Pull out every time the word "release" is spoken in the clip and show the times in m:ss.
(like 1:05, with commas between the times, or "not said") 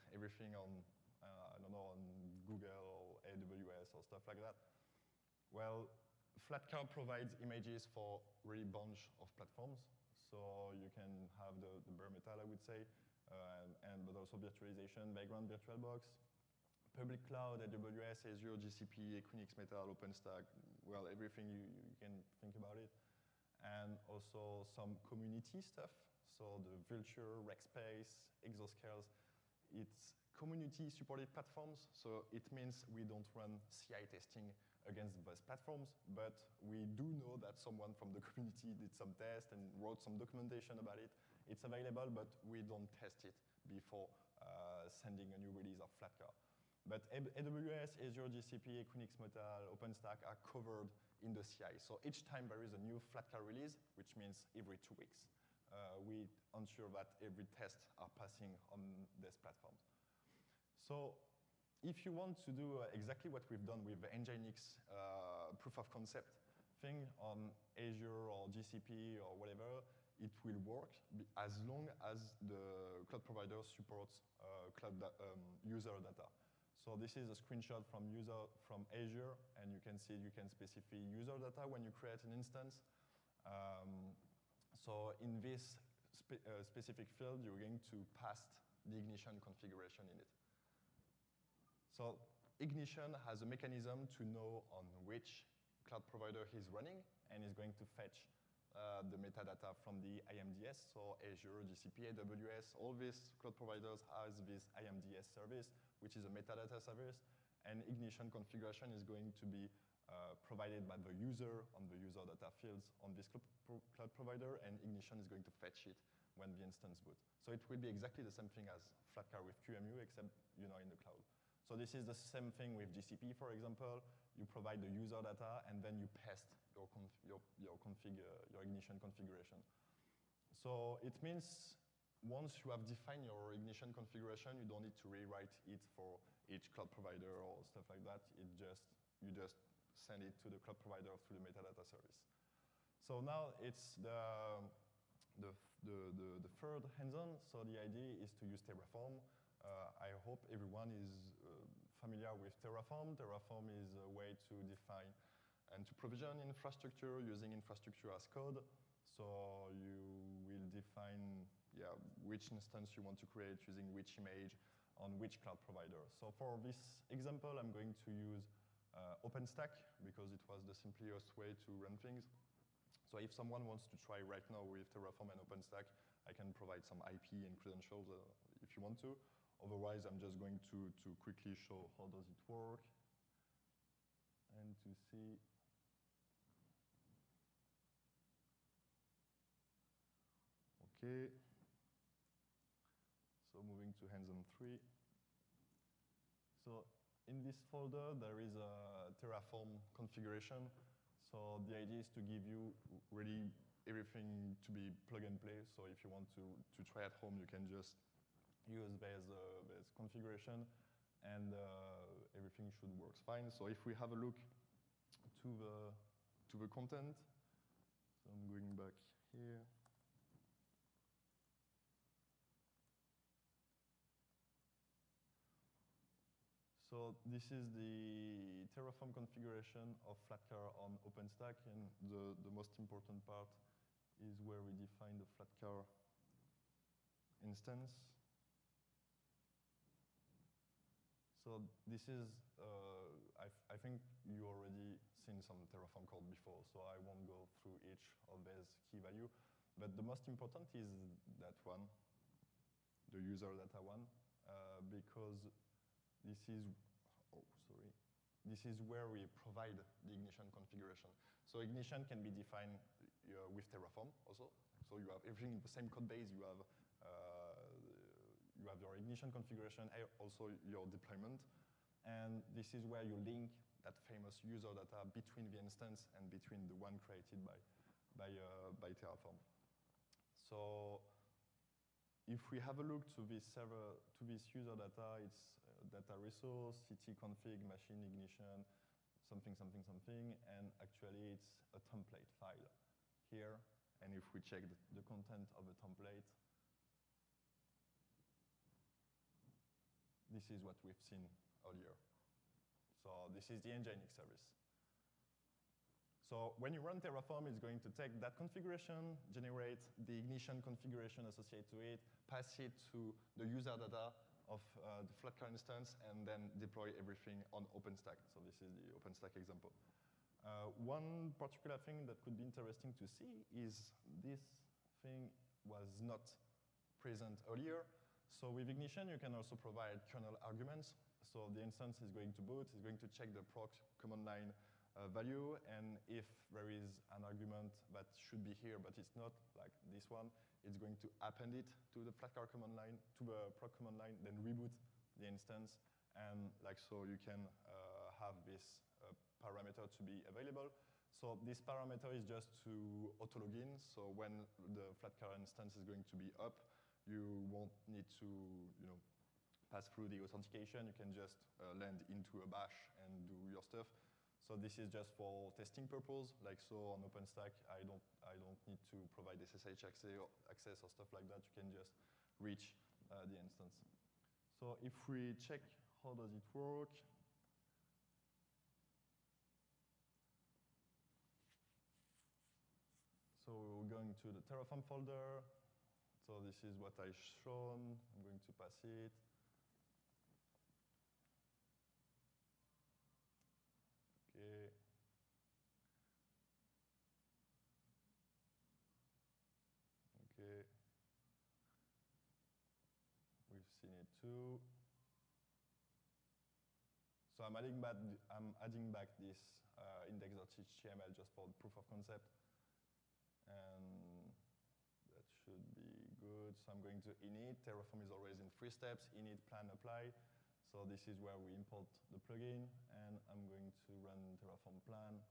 0:45, 0:53.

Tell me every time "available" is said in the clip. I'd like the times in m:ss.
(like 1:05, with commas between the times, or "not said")
0:41, 5:50.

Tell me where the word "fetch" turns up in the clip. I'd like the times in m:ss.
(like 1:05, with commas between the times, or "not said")
1:37, 1:55.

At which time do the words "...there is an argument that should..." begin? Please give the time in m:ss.
5:36.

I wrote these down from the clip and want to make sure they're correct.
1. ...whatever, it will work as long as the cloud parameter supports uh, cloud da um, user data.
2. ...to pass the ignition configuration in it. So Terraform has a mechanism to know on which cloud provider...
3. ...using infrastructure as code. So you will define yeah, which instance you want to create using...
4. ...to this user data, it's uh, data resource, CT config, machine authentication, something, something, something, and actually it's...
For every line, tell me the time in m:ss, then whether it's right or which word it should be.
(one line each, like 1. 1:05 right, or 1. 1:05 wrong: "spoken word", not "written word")
1. 1:09 wrong: "provider", not "parameter"
2. 1:27 wrong: "Ignition", not "Terraform"
3. 2:37 right
4. 4:44 wrong: "ignition", not "authentication".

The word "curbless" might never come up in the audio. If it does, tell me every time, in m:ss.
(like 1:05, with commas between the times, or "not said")
not said.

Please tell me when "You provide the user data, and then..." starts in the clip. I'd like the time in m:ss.
2:04.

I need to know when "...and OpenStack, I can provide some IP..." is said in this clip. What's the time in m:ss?
2:55.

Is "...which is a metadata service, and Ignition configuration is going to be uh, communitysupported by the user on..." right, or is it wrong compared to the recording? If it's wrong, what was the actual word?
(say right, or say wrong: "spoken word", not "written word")
wrong: "provided", not "communitysupported".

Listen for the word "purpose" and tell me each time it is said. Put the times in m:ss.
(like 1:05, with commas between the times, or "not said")
6:05.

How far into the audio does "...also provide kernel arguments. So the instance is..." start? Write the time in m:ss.
5:29.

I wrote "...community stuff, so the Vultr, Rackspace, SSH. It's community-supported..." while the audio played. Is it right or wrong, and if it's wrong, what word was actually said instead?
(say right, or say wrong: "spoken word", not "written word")
wrong: "Exoscales", not "SSH".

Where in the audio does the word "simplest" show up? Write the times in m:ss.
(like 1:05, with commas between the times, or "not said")
2:50.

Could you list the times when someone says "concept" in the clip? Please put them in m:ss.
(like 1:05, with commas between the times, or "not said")
1:05, 6:51.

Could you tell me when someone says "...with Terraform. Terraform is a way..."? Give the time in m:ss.
2:32.